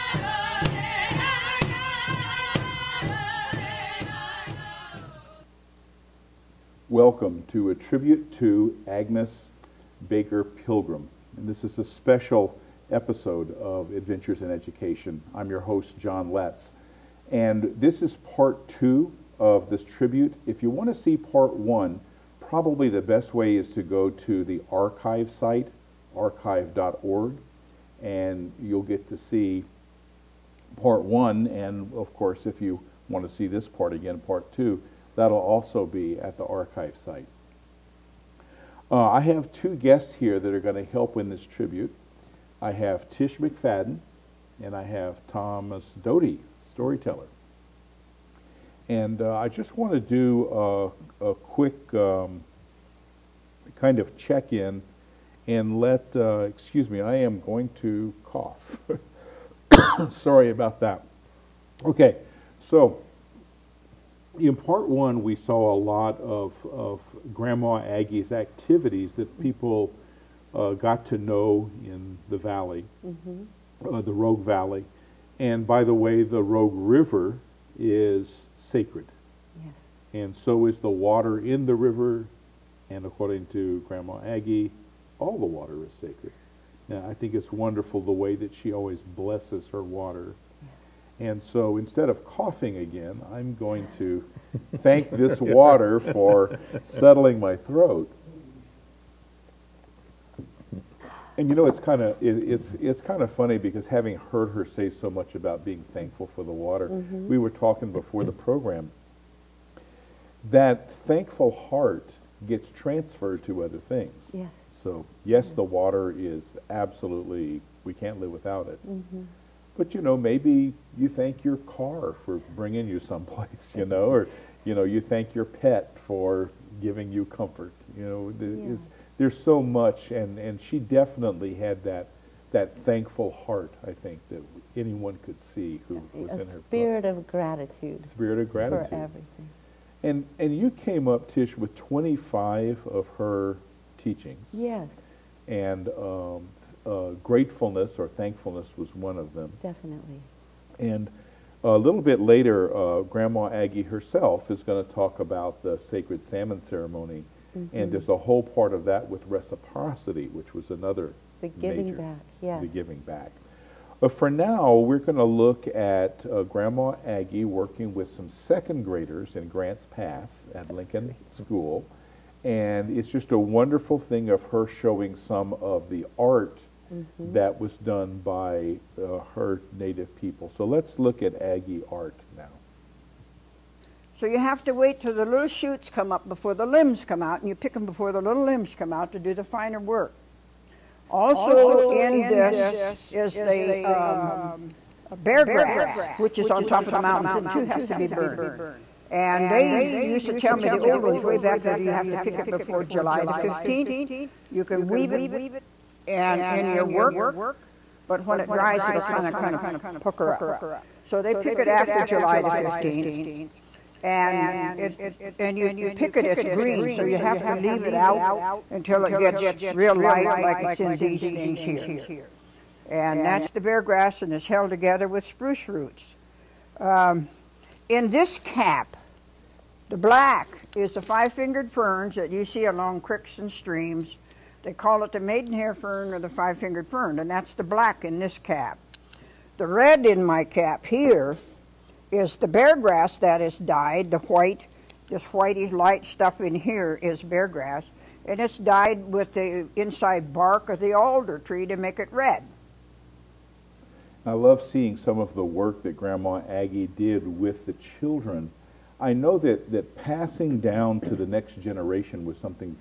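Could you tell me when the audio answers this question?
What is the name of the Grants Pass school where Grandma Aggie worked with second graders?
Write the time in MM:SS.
02:50.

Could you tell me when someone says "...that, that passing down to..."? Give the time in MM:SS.
04:19.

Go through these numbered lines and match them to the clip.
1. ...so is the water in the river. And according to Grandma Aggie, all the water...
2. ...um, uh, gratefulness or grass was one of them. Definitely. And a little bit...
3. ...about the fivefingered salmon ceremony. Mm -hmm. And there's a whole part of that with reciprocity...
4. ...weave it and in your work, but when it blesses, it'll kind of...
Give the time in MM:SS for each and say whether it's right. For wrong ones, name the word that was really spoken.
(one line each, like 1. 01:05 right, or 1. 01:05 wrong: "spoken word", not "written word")
1. 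01:20 right
2. 02:25 wrong: "thankfulness", not "grass"
3. 02:35 wrong: "sacred", not "fivefingered"
4. 03:24 wrong: "dries", not "blesses".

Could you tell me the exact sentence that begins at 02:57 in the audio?
that was done by uh, her native people.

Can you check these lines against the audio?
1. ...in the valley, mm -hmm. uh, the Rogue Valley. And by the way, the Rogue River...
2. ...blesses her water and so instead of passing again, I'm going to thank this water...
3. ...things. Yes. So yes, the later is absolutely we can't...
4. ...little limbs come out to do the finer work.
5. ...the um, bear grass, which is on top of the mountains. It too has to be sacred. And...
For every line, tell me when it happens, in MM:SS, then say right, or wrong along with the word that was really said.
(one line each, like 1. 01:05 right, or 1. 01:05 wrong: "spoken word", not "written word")
1. 01:11 right
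2. 01:29 wrong: "coughing", not "passing"
3. 01:53 wrong: "water", not "later"
4. 03:08 right
5. 03:13 wrong: "burned", not "sacred".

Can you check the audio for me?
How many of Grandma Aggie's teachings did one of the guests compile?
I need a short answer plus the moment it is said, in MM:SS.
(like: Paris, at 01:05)
25, at 02:21.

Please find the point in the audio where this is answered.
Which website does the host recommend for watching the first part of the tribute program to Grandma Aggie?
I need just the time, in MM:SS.
00:26.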